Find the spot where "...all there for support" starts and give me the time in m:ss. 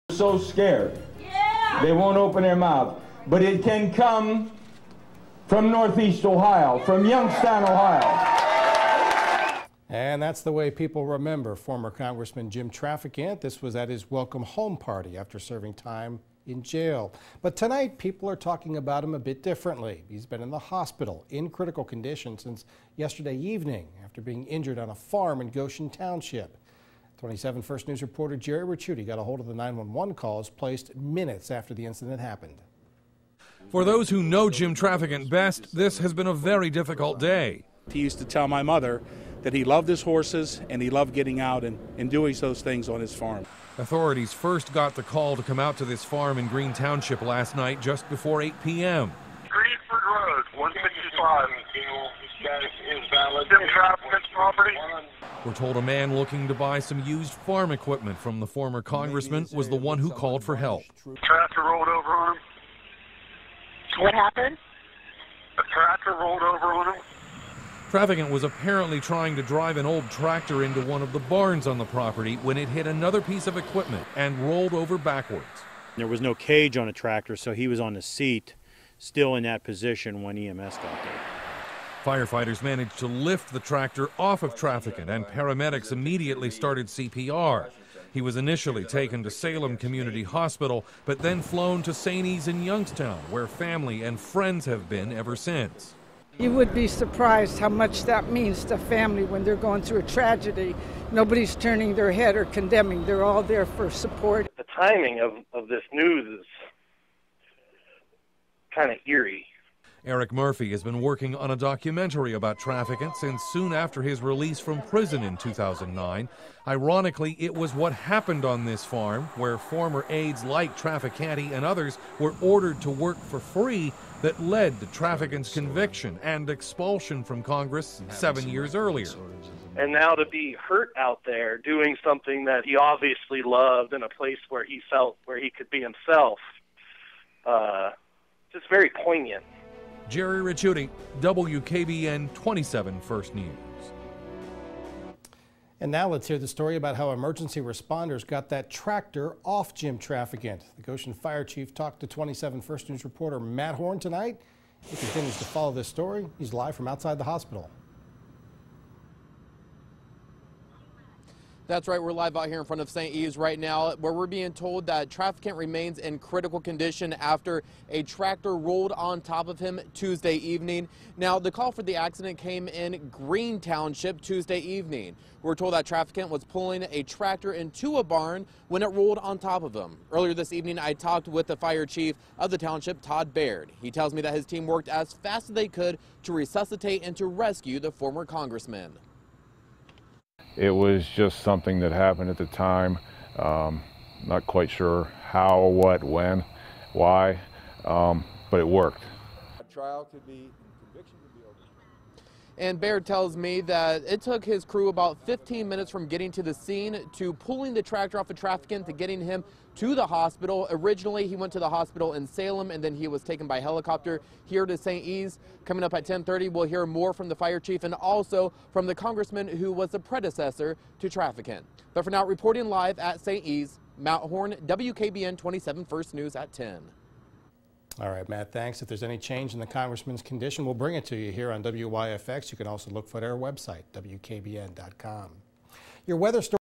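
1:43.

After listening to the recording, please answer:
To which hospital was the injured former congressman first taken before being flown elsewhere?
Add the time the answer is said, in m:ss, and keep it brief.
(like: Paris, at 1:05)
Salem Community Hospital, at 1:29.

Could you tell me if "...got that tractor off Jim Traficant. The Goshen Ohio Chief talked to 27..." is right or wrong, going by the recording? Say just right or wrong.
wrong.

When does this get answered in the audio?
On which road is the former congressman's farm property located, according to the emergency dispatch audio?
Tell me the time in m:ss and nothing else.
0:49.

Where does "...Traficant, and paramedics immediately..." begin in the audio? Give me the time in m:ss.
1:24.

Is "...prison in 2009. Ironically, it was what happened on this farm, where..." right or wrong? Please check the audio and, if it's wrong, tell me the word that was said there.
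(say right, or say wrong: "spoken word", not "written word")
right.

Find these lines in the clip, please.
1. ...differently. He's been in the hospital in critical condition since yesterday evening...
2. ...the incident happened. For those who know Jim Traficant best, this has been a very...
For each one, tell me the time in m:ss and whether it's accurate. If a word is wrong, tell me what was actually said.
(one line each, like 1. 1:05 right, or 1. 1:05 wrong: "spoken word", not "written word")
1. 0:19 right
2. 0:31 right.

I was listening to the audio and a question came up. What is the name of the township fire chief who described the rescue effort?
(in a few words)
Todd Baird.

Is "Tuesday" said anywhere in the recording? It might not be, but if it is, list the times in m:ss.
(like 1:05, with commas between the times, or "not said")
2:49, 2:54.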